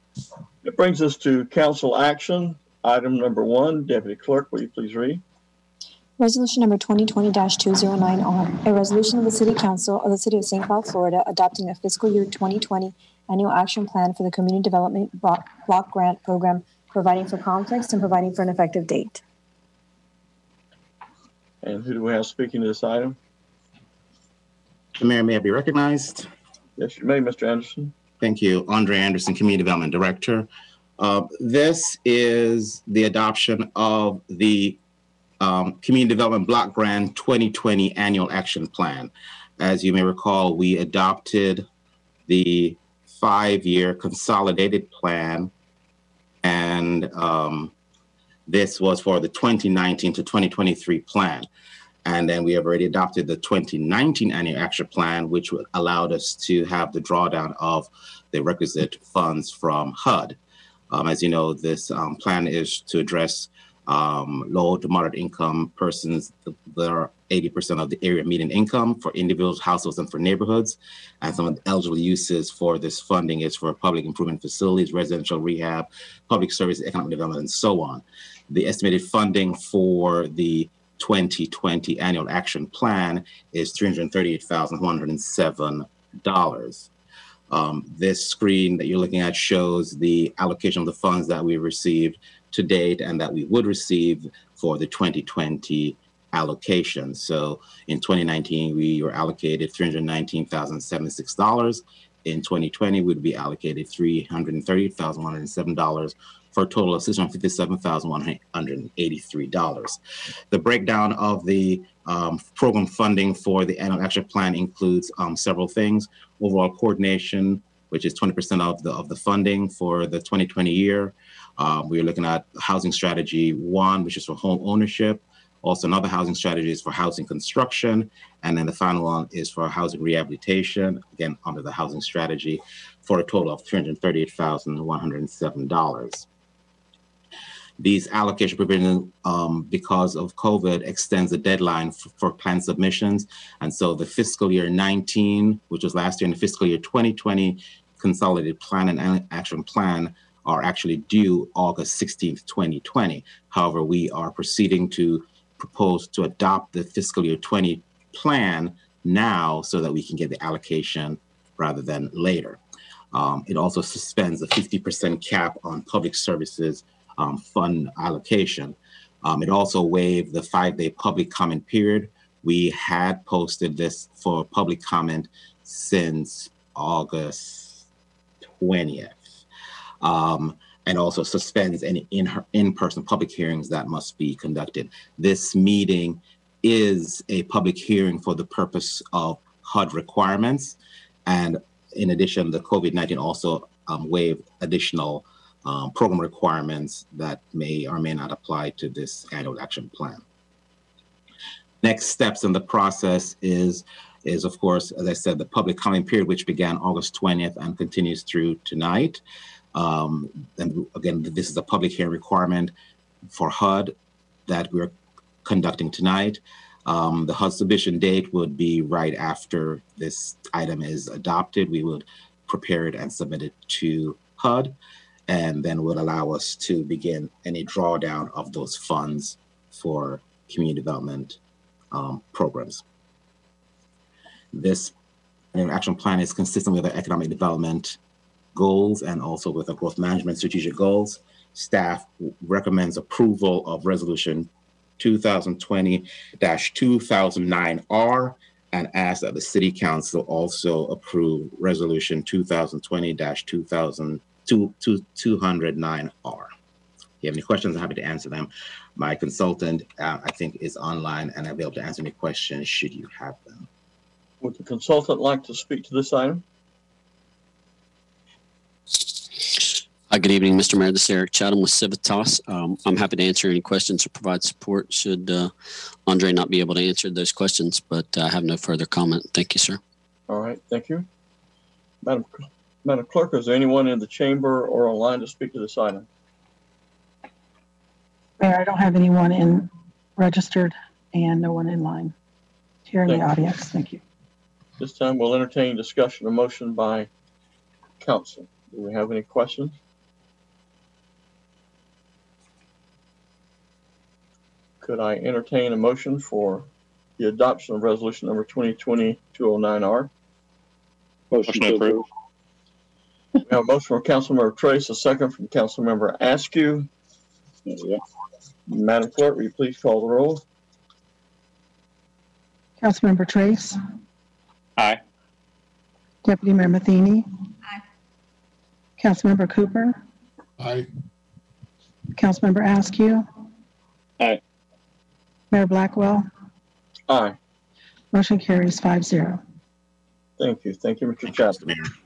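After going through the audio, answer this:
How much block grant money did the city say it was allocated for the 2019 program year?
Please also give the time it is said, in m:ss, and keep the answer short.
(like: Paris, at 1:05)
$319,076, at 1:39.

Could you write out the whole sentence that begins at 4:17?
If you have any questions, I'm happy to answer them.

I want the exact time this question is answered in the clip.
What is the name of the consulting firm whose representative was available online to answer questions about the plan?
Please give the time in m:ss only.
4:31.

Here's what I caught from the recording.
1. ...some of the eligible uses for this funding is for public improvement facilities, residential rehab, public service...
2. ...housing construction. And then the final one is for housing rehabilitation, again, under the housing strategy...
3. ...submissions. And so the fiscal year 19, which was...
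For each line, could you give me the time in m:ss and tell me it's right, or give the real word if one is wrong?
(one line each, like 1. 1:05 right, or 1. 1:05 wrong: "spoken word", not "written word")
1. 1:11 right
2. 2:06 right
3. 2:22 right.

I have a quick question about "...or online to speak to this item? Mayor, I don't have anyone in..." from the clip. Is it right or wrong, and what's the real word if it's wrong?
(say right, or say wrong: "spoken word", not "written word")
right.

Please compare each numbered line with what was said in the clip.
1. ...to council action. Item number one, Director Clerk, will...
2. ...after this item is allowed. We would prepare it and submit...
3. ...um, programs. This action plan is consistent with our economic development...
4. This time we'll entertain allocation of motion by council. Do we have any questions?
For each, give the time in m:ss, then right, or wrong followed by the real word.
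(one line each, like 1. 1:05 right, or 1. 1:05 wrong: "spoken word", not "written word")
1. 0:01 wrong: "Deputy", not "Director"
2. 3:39 wrong: "adopted", not "allowed"
3. 3:51 right
4. 4:54 wrong: "discussion", not "allocation".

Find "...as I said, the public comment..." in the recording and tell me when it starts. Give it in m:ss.
3:24.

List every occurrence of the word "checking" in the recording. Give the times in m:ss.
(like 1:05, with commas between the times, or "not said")
not said.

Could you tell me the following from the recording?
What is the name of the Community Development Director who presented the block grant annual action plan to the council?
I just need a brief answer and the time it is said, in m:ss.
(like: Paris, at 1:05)
Andre Anderson, at 0:28.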